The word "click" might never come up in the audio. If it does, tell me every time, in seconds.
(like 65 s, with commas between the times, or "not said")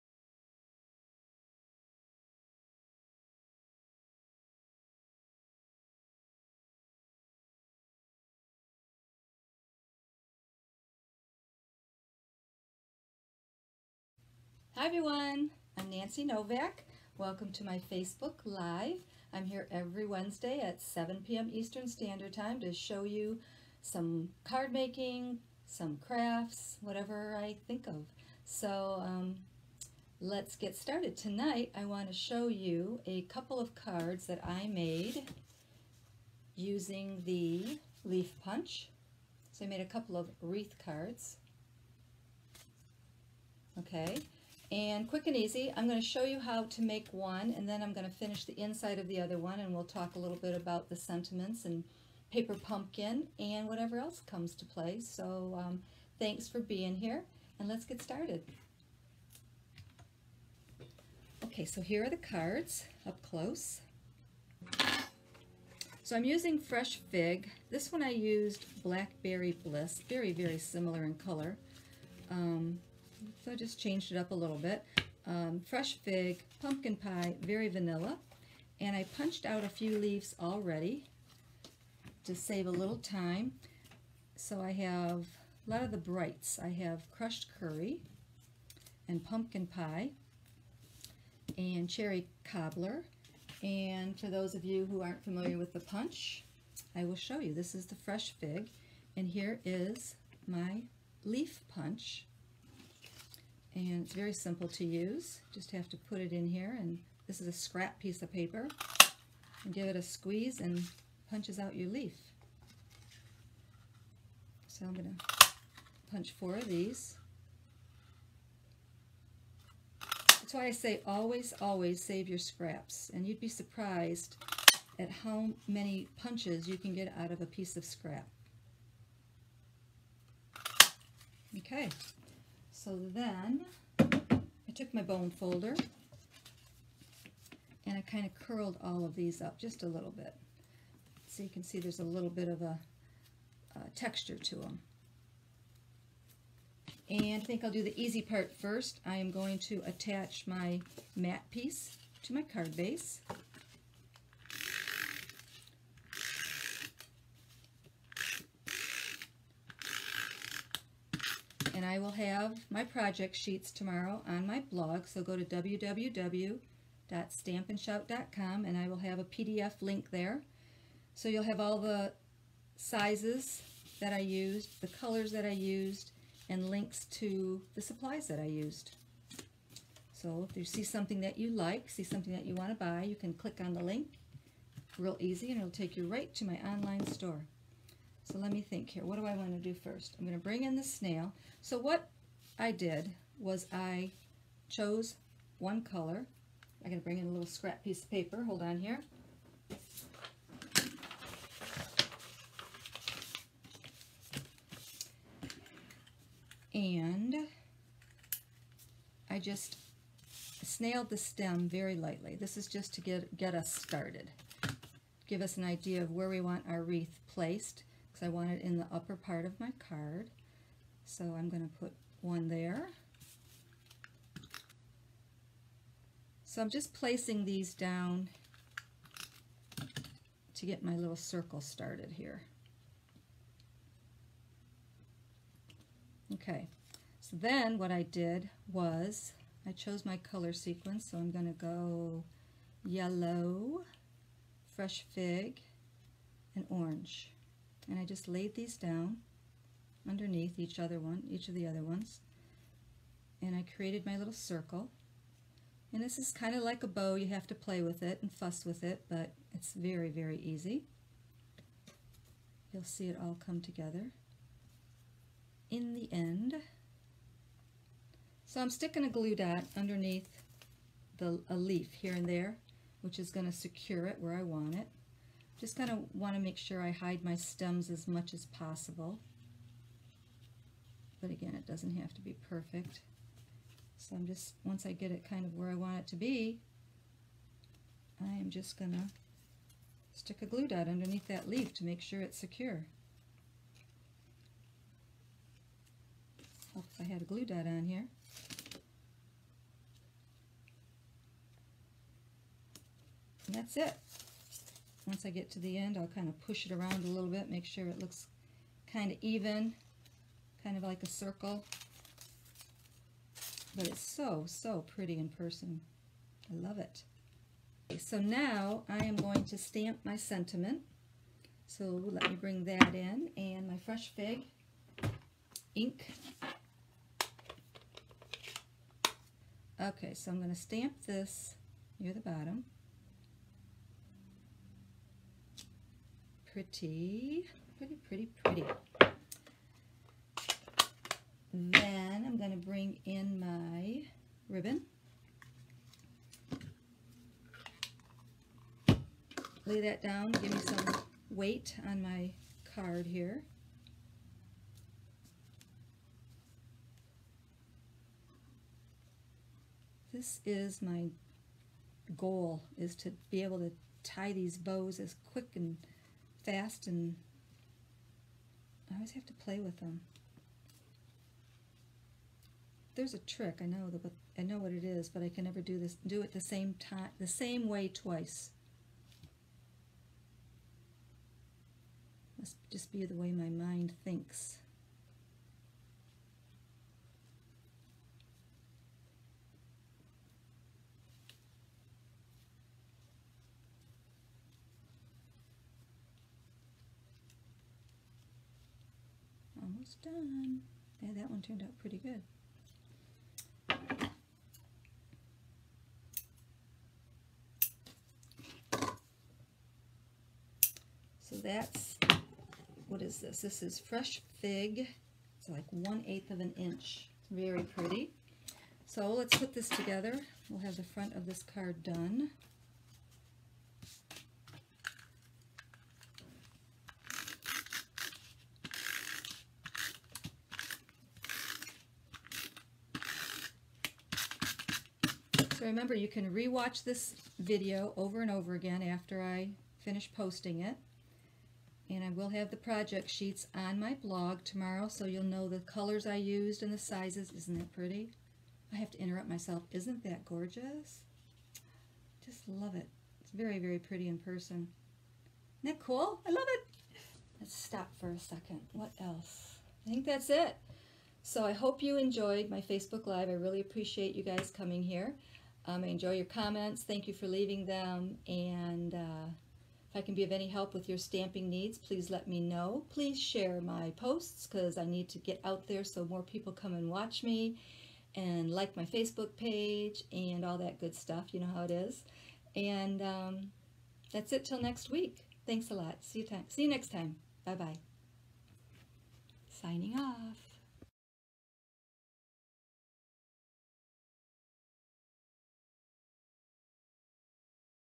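183 s.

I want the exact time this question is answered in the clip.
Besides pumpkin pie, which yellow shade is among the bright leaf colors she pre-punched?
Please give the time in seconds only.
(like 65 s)
87 s.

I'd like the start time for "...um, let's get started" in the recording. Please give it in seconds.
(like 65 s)
29 s.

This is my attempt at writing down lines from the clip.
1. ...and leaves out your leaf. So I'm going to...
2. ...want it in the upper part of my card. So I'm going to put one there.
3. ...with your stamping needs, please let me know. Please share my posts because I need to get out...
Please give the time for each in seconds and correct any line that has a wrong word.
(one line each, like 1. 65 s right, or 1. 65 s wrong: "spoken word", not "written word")
1. 110 s wrong: "punches", not "leaves"
2. 218 s right
3. 470 s right.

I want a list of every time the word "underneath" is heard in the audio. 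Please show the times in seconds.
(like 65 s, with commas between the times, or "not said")
250 s, 269 s, 290 s.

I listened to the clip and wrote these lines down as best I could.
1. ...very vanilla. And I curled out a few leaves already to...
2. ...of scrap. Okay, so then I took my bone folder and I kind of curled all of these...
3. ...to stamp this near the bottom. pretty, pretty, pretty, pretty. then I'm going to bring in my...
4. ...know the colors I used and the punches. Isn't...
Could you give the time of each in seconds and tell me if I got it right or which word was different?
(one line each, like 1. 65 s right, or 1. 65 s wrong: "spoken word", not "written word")
1. 77 s wrong: "punched", not "curled"
2. 127 s right
3. 330 s right
4. 445 s wrong: "sizes", not "punches".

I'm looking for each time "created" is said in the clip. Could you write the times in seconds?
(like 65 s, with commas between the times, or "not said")
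253 s.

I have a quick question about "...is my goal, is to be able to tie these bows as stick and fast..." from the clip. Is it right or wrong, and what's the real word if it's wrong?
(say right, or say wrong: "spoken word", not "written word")
wrong: "quick", not "stick".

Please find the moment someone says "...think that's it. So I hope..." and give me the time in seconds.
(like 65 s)
459 s.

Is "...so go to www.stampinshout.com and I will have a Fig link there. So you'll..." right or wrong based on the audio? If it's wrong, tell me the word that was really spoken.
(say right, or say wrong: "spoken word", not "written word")
wrong: "PDF", not "Fig".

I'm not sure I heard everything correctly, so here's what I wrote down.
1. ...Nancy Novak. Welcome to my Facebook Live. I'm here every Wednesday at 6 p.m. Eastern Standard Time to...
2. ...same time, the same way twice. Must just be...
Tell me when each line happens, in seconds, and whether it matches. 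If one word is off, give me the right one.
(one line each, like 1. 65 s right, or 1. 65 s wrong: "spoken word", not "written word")
1. 15 s wrong: "7", not "6"
2. 376 s right.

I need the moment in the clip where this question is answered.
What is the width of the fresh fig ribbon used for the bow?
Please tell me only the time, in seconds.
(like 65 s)
415 s.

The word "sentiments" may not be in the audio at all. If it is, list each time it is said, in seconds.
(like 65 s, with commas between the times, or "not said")
50 s, 320 s.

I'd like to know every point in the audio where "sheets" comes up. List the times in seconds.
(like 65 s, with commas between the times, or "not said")
163 s, 443 s.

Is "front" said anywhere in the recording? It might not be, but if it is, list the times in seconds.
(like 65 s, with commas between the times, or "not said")
420 s.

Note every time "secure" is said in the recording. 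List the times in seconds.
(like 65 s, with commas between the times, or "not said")
273 s, 292 s.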